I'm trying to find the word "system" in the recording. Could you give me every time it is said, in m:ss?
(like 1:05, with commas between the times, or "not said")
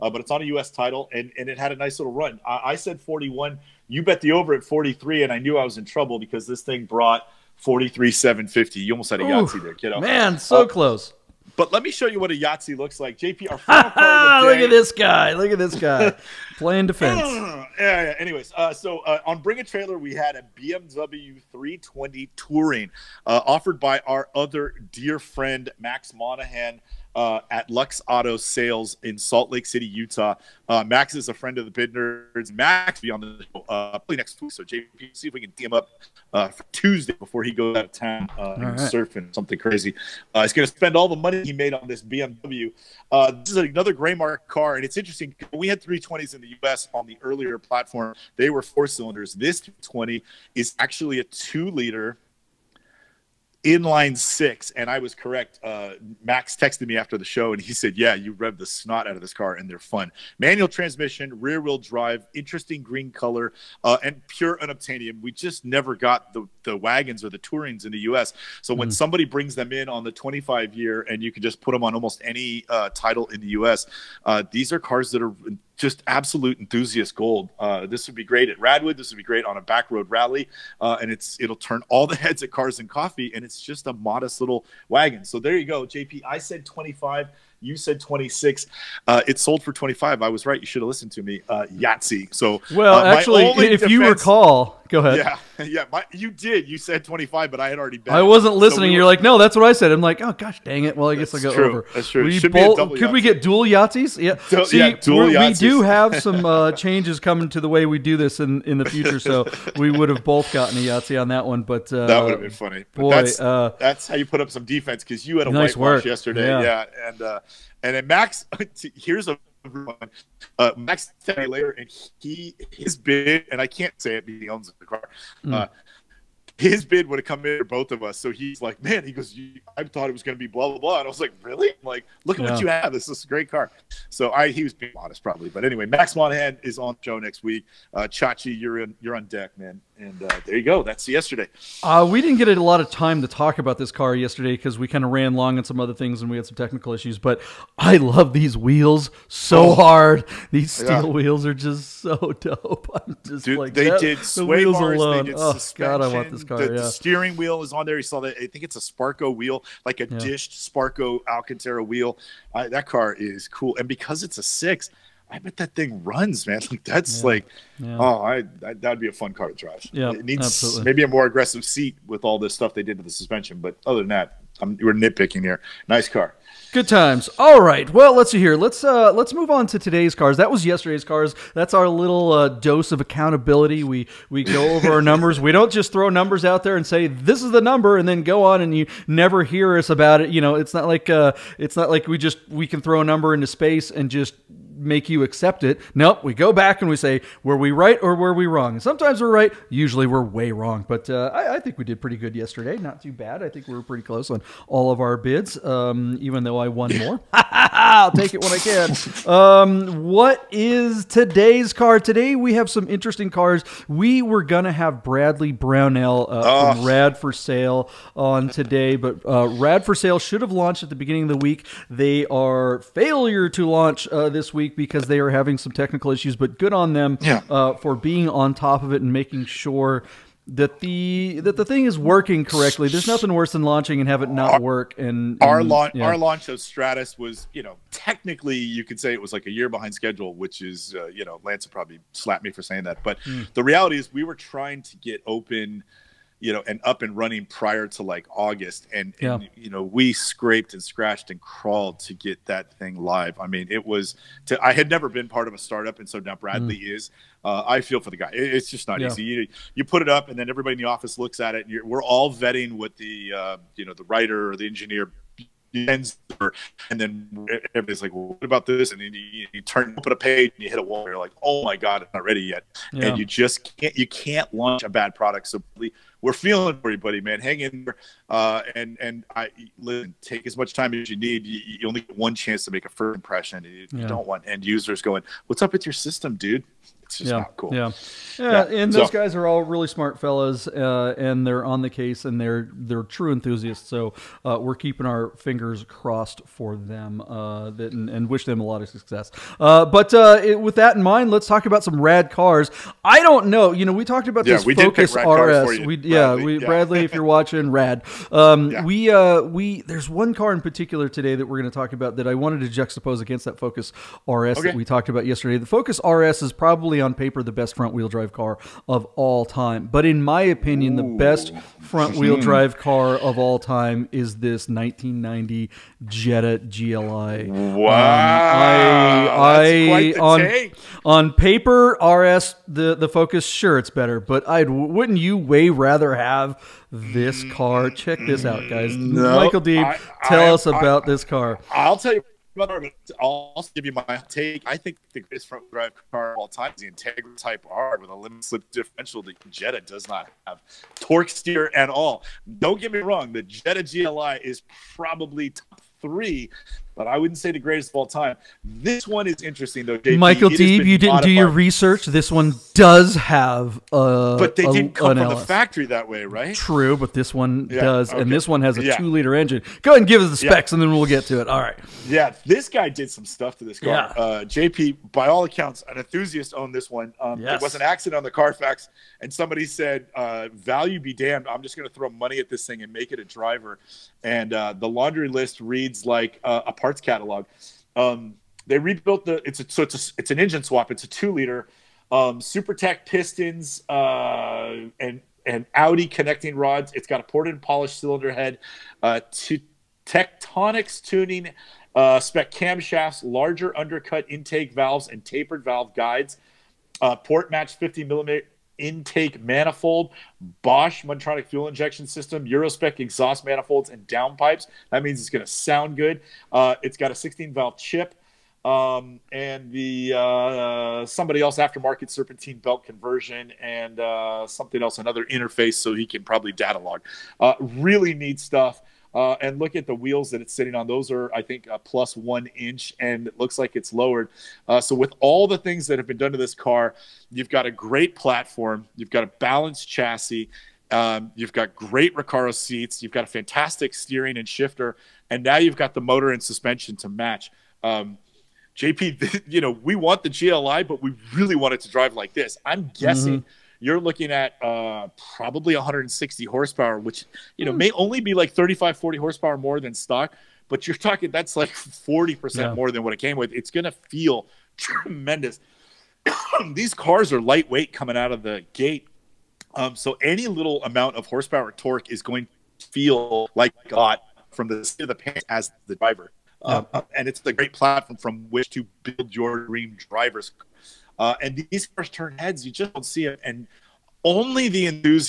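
4:45, 6:52.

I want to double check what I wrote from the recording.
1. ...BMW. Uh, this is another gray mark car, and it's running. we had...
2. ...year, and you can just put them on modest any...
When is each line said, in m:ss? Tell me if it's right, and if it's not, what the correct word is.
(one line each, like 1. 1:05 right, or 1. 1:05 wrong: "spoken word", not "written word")
1. 0:42 wrong: "interesting", not "running"
2. 1:10 wrong: "almost", not "modest".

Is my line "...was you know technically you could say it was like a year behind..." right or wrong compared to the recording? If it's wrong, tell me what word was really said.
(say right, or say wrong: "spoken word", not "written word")
right.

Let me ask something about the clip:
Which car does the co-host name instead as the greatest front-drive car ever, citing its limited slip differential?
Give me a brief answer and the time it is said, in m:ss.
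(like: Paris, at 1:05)
Integra Type R, at 5:46.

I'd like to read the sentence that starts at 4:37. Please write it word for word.
Hang in there, uh, and and I listen, take as much time as you need.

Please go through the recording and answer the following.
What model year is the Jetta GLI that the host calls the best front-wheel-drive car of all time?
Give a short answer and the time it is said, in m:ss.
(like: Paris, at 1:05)
1990, at 5:24.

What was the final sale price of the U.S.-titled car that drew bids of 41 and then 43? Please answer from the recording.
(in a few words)
43,750.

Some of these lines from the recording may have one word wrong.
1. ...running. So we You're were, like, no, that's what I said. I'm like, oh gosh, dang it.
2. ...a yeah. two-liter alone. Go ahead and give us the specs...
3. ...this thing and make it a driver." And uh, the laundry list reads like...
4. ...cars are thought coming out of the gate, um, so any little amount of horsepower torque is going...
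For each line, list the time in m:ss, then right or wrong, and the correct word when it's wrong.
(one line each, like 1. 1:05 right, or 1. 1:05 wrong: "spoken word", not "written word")
1. 1:38 wrong: "listening", not "running"
2. 6:08 wrong: "engine", not "alone"
3. 6:22 right
4. 7:46 wrong: "lightweight", not "thought".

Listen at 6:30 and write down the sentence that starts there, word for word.
It's a two liter um, Supertech pistons uh, and and Audi connecting rods.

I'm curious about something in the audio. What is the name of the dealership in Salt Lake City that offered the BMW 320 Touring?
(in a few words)
Lux Auto Sales.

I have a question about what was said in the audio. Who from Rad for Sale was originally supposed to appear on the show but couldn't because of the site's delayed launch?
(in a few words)
Bradley Brownell.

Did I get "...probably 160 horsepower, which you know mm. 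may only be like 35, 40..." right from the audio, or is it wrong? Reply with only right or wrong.
right.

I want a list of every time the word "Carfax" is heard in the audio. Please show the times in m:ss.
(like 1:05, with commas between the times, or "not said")
6:18.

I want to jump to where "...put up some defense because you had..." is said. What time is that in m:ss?
1:54.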